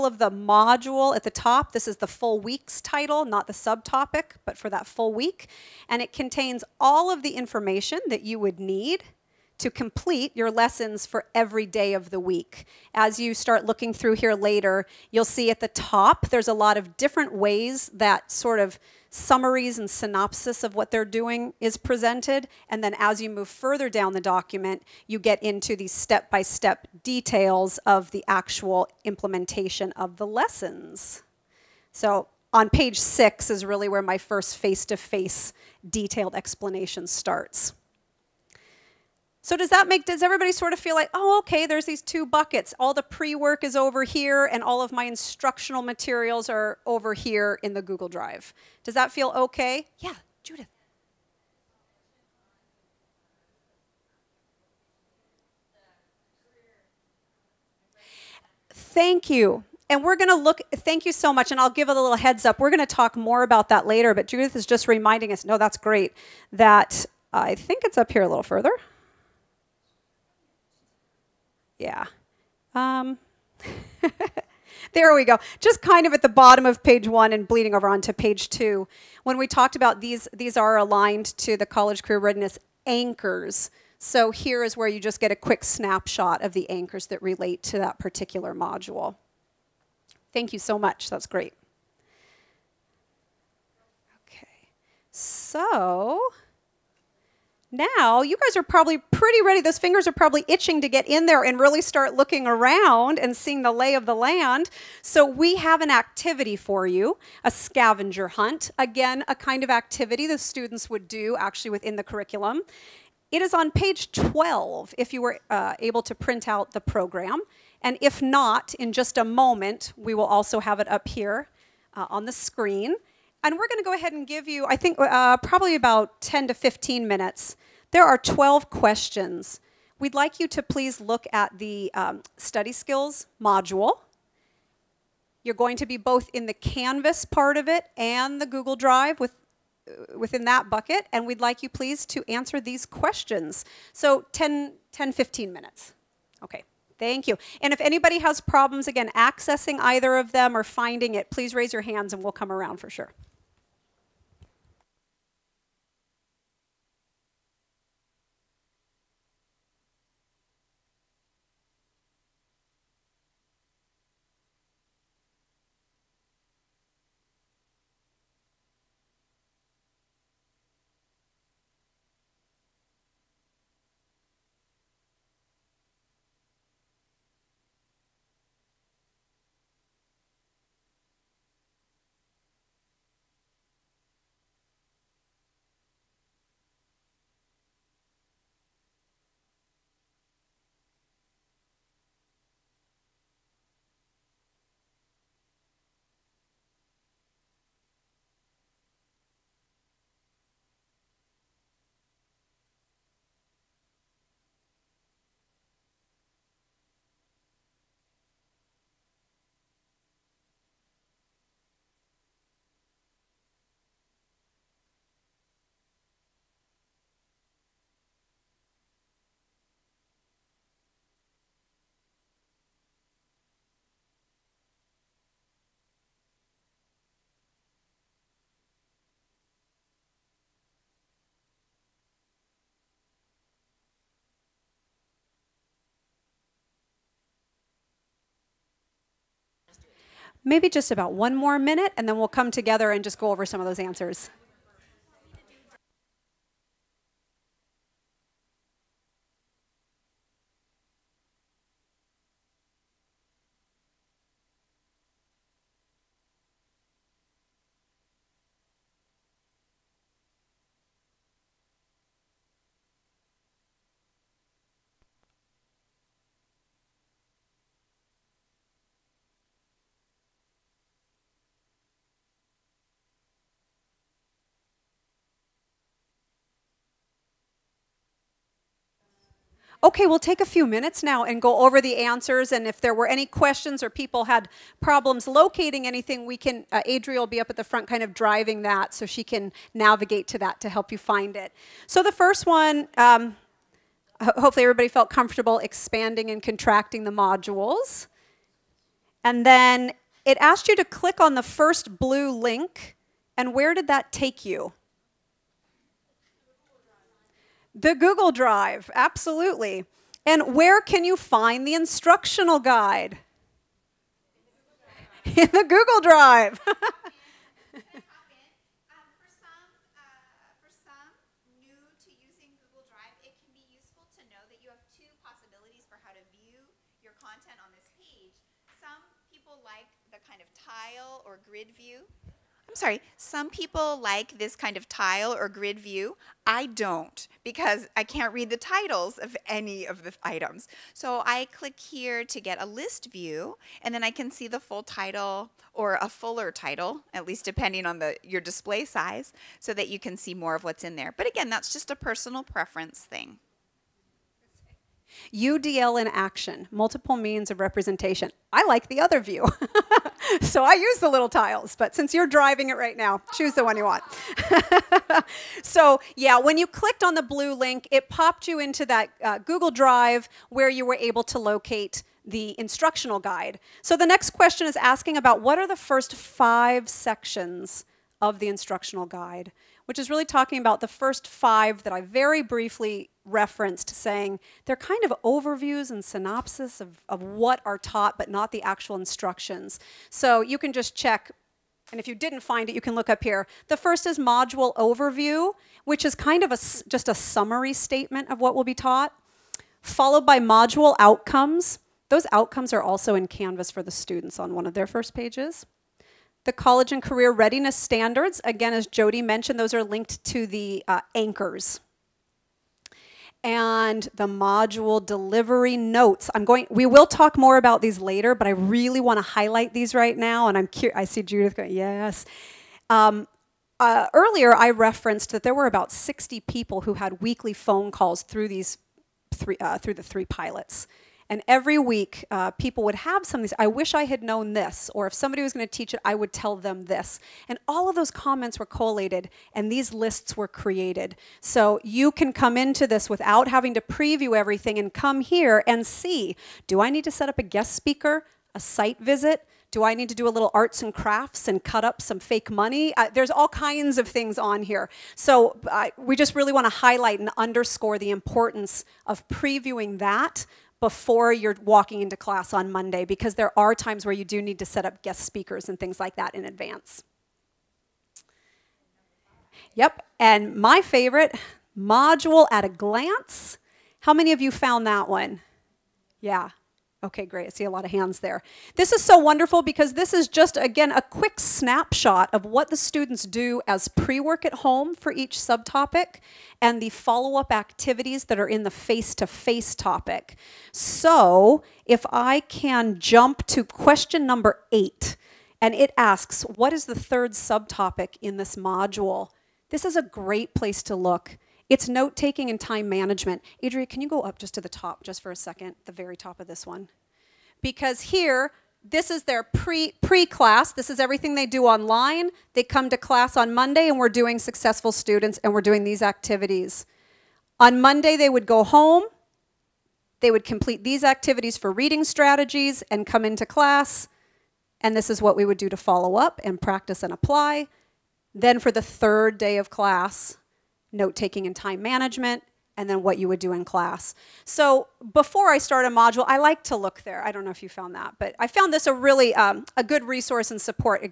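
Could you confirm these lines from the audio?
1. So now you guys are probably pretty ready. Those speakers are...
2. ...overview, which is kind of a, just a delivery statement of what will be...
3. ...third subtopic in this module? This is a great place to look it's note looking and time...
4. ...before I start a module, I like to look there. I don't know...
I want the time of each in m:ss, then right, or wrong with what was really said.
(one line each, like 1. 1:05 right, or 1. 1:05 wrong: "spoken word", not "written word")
1. 1:35 wrong: "fingers", not "speakers"
2. 6:34 wrong: "summary", not "delivery"
3. 8:17 wrong: "taking", not "looking"
4. 8:55 right.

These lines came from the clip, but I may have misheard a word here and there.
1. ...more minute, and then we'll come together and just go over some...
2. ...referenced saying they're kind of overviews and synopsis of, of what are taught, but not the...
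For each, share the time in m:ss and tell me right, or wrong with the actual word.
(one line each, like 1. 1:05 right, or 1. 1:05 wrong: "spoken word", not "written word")
1. 4:01 right
2. 6:23 right.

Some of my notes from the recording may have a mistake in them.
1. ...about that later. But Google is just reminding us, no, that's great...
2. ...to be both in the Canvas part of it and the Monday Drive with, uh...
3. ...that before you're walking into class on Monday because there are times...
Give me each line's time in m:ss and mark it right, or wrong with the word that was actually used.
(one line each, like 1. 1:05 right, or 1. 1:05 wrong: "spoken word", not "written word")
1. 1:03 wrong: "Judith", not "Google"
2. 2:15 wrong: "Google", not "Monday"
3. 7:39 right.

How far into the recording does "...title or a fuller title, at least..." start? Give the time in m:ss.
5:44.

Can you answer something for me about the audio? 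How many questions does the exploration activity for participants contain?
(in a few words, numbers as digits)
12.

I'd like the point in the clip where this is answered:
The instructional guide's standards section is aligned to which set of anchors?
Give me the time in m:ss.
1:21.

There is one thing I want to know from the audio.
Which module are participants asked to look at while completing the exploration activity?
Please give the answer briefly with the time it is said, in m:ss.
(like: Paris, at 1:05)
Study skills, at 2:12.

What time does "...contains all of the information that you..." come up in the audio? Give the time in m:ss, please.
0:06.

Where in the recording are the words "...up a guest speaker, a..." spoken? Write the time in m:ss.
7:27.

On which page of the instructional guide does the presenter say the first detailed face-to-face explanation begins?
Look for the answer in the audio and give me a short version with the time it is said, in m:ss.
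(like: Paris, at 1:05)
6, at 0:32.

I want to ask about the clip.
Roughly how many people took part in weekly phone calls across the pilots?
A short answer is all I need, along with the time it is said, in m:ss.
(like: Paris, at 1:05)
About 60, at 7:05.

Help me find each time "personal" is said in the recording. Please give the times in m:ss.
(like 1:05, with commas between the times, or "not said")
5:51.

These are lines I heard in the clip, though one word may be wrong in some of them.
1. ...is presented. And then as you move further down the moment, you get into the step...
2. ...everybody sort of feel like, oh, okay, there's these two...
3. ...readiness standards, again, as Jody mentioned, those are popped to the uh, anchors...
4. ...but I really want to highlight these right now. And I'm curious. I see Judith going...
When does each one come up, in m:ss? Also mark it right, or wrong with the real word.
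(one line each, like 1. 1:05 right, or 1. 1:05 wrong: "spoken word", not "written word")
1. 0:21 wrong: "document", not "moment"
2. 0:40 right
3. 6:47 wrong: "linked", not "popped"
4. 6:58 right.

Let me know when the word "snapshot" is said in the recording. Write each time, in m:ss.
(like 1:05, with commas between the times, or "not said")
1:25, 8:01.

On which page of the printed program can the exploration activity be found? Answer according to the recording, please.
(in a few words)
12.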